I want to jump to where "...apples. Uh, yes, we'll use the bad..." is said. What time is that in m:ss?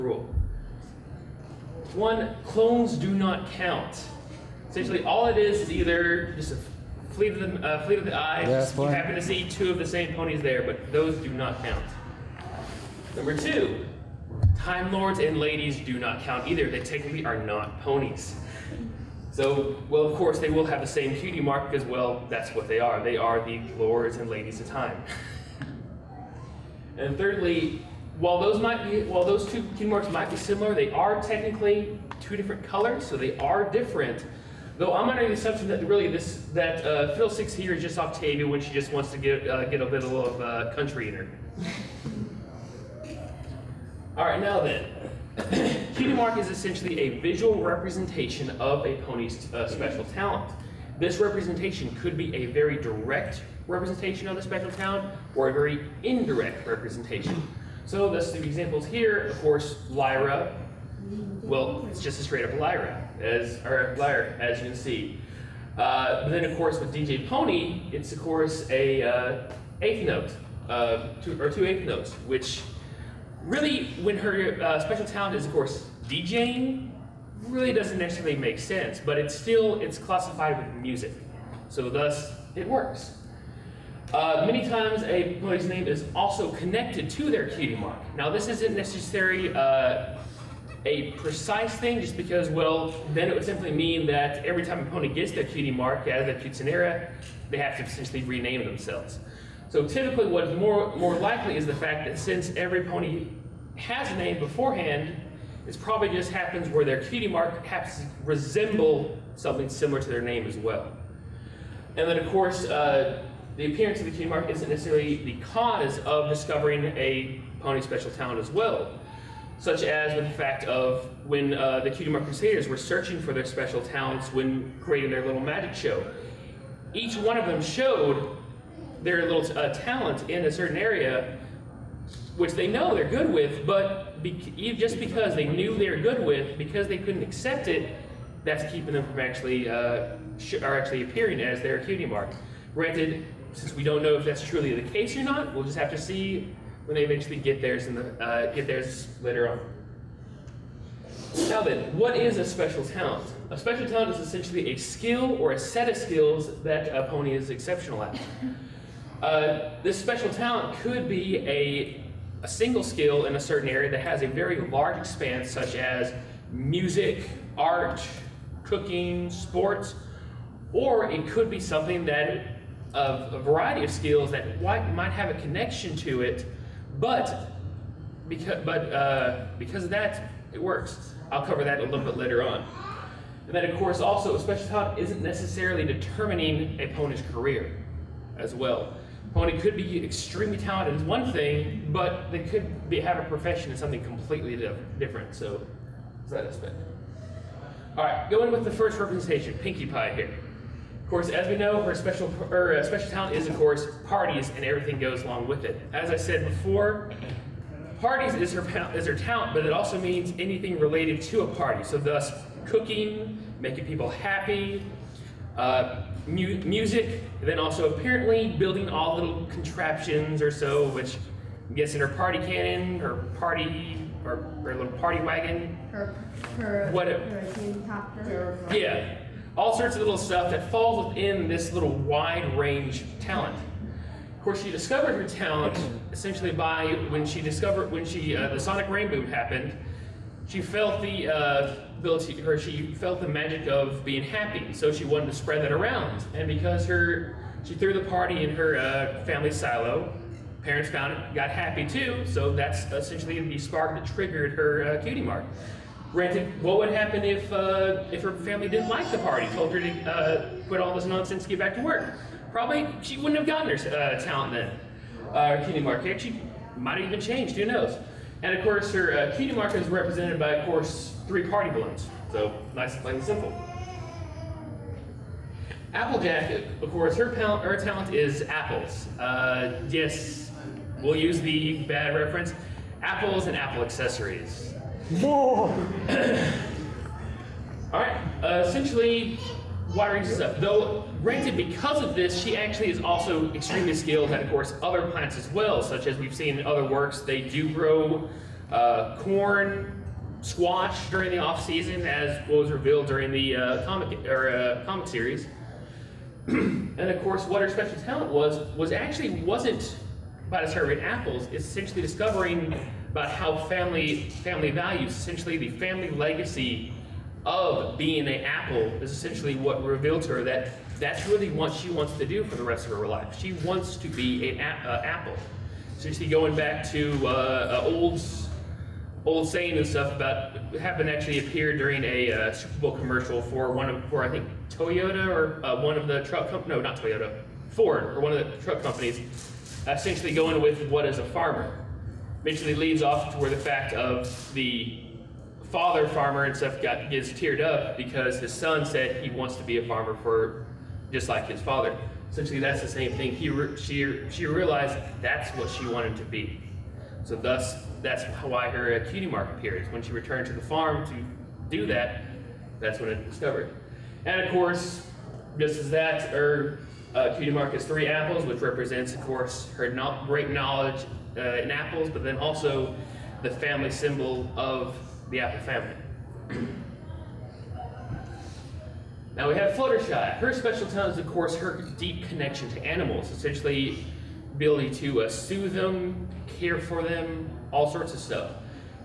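4:38.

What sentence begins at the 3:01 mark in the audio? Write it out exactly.
I'll cover that a little bit later on.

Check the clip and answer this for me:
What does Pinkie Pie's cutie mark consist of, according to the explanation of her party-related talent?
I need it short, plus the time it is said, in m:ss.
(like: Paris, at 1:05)
three party balloons, at 4:31.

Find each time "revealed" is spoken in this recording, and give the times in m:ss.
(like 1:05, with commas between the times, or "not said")
5:02, 5:19.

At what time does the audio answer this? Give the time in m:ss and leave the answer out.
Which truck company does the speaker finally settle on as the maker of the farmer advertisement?
5:37.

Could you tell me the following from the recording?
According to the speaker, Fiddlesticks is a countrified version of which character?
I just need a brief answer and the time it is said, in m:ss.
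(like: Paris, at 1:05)
Octavia, at 0:37.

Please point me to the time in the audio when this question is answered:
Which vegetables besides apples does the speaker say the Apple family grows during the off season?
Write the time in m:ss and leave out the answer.
4:59.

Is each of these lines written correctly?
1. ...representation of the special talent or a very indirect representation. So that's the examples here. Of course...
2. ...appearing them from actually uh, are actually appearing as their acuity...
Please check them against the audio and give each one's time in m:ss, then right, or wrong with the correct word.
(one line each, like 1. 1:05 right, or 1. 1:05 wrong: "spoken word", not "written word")
1. 0:53 right
2. 2:18 wrong: "keeping", not "appearing".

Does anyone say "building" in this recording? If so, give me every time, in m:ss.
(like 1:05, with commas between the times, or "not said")
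3:38.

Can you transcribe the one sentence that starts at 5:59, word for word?
When she returned to the farm to do that, that's when it discovered.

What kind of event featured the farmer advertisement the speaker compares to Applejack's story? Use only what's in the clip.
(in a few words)
Super Bowl commercial.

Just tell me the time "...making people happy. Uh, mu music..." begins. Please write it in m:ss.
3:33.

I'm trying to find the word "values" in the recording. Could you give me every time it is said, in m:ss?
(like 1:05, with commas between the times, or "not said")
5:14.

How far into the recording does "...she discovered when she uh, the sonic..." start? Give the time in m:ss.
3:57.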